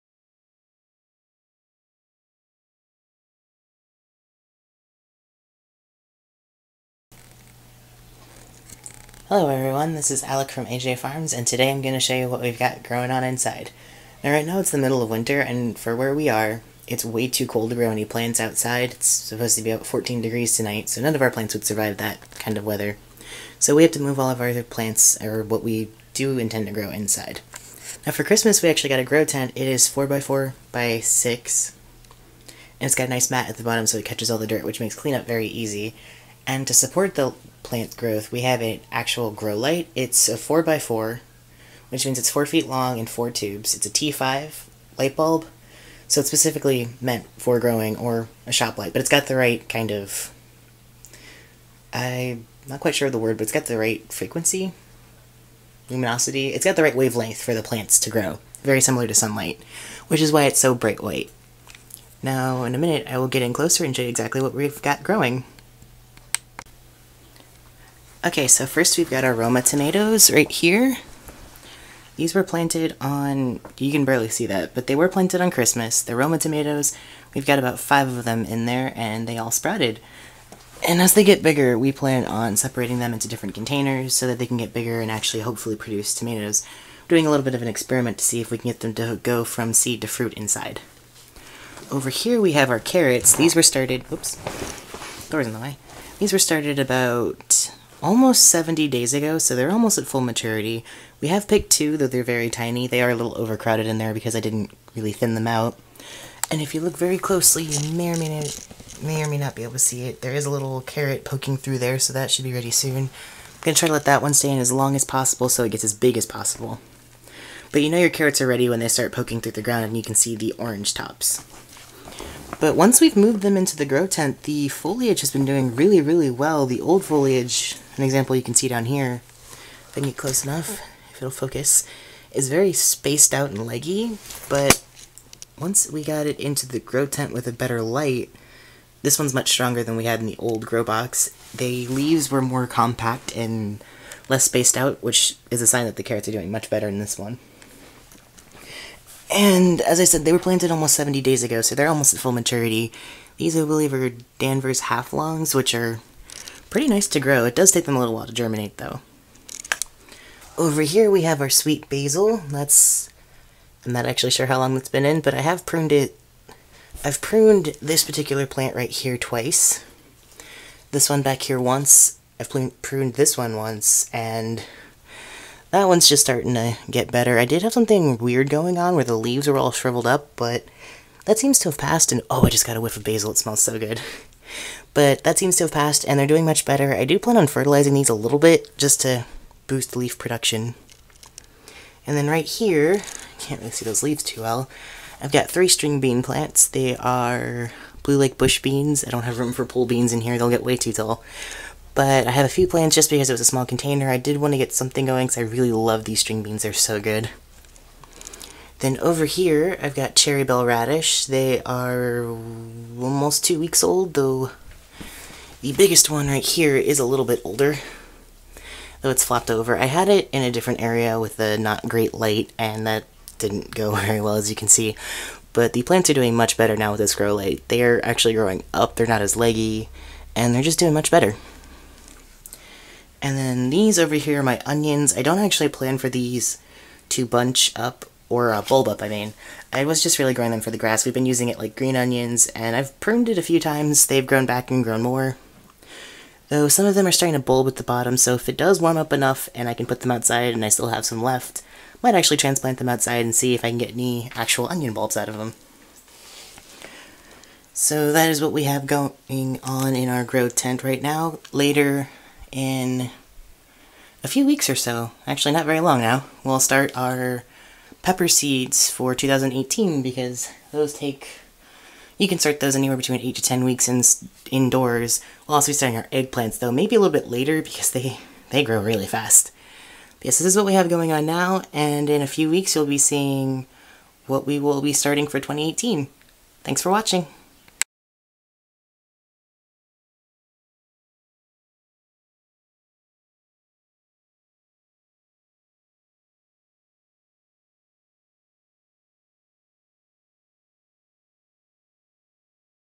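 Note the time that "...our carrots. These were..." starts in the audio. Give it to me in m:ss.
1:32.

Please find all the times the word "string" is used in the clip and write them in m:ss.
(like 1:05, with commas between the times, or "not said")
3:15, 3:26.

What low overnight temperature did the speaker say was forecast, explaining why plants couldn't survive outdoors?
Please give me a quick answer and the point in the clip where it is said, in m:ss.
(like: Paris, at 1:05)
14 degrees, at 0:19.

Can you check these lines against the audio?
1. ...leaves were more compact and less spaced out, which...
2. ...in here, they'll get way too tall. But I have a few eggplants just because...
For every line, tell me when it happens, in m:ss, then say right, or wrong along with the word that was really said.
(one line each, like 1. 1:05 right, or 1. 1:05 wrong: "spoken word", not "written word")
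1. 2:21 right
2. 3:20 wrong: "plants", not "eggplants".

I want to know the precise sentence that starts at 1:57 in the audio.
But you know your carrots are ready when they start poking through the ground and you can see the orange tops.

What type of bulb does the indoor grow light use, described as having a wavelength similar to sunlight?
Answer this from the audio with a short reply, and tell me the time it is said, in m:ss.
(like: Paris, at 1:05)
T5, at 0:43.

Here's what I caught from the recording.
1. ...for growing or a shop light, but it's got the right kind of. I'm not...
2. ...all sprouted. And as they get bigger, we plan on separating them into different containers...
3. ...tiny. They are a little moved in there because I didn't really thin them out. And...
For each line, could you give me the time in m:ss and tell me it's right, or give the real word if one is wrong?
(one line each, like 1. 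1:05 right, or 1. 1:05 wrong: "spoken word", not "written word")
1. 0:47 right
2. 1:19 right
3. 1:42 wrong: "overcrowded", not "moved".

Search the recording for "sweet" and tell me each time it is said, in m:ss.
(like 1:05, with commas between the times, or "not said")
2:41.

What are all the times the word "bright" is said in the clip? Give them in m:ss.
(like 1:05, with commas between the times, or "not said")
1:00.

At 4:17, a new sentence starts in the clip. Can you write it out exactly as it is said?
So that is what we have going on in our grow tent right now.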